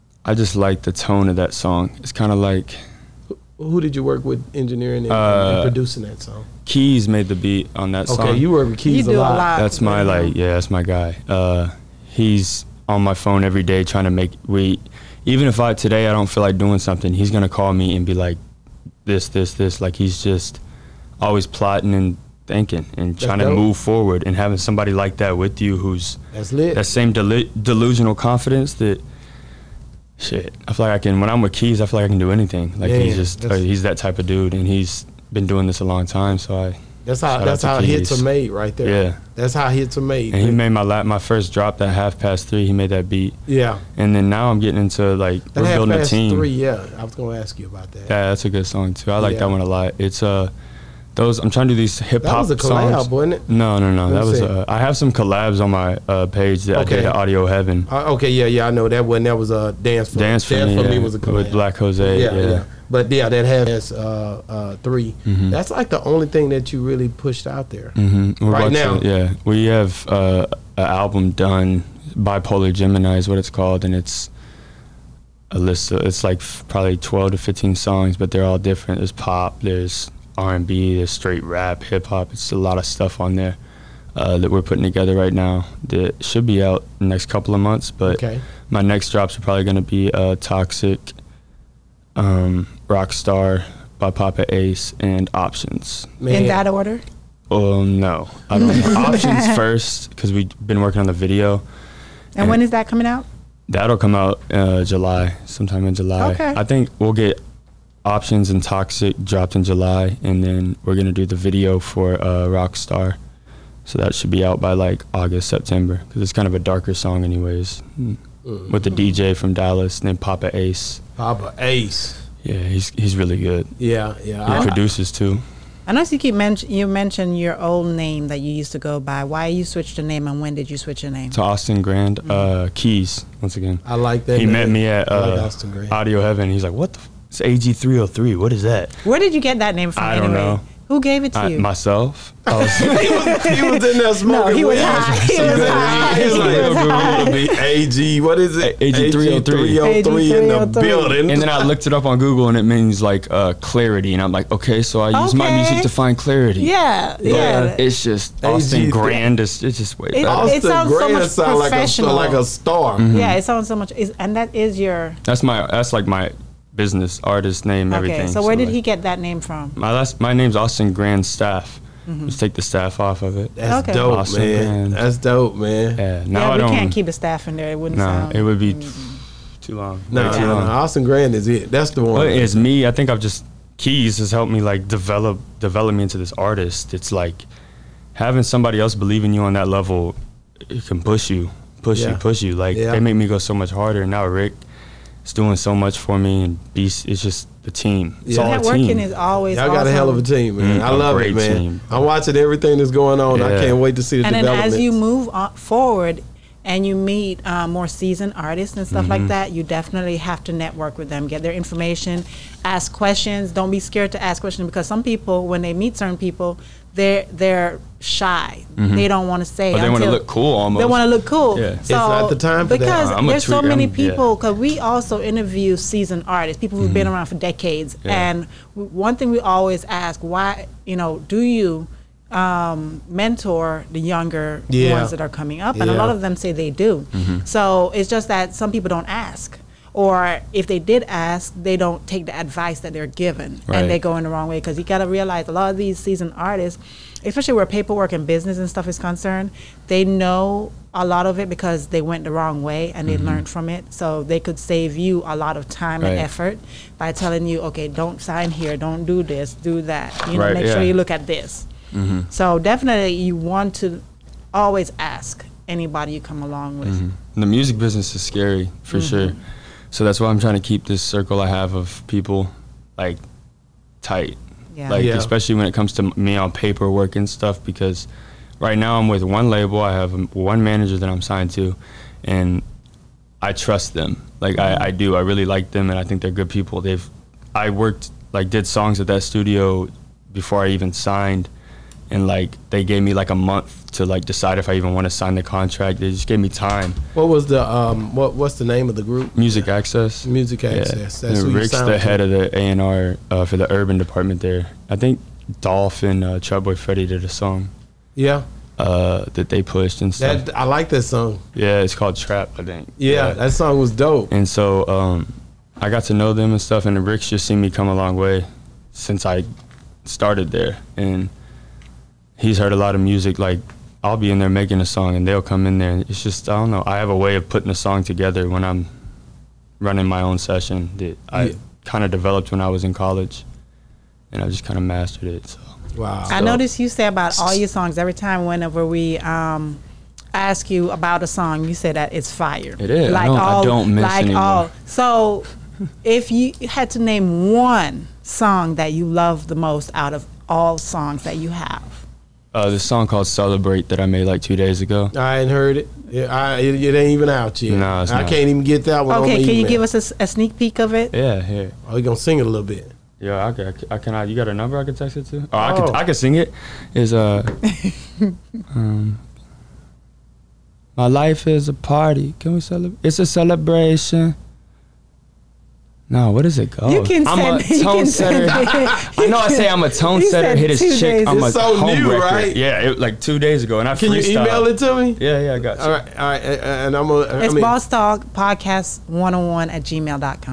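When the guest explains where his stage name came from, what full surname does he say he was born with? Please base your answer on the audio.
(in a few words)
Grandstaff.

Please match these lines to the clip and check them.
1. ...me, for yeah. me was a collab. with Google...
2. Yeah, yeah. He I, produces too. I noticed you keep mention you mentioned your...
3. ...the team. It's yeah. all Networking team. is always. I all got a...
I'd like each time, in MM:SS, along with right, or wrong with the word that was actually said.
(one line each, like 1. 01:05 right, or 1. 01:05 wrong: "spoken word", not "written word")
1. 01:00 wrong: "Black", not "Google"
2. 02:03 right
3. 03:17 right.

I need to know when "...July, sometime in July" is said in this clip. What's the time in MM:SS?
01:44.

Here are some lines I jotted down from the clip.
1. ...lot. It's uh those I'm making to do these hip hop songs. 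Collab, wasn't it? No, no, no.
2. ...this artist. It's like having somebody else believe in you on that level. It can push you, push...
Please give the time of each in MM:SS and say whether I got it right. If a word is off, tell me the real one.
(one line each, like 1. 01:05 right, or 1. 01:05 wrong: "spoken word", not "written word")
1. 00:49 wrong: "trying", not "making"
2. 03:06 right.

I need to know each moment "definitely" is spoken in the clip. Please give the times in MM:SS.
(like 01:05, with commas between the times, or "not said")
03:29, 04:22.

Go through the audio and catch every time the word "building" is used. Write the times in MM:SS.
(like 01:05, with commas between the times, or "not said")
00:45, 02:30.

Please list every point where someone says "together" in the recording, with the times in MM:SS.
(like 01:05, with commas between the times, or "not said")
01:24, 05:28.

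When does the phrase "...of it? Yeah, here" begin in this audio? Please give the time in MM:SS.
06:00.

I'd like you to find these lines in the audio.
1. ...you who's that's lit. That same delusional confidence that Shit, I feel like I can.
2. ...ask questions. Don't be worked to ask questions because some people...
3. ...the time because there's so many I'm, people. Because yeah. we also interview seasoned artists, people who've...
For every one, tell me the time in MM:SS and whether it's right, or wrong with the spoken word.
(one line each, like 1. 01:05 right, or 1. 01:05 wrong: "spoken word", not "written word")
1. 00:25 right
2. 03:32 wrong: "scared", not "worked"
3. 03:42 right.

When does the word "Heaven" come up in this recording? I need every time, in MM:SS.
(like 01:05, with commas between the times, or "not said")
00:57, 02:16.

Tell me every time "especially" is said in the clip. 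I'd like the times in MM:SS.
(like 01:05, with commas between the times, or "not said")
04:07, 04:35.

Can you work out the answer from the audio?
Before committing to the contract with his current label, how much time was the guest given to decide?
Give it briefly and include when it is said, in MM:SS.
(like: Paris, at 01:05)
A month, at 04:53.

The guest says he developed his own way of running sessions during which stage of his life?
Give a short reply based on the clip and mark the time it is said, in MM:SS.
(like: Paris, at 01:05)
College, at 05:32.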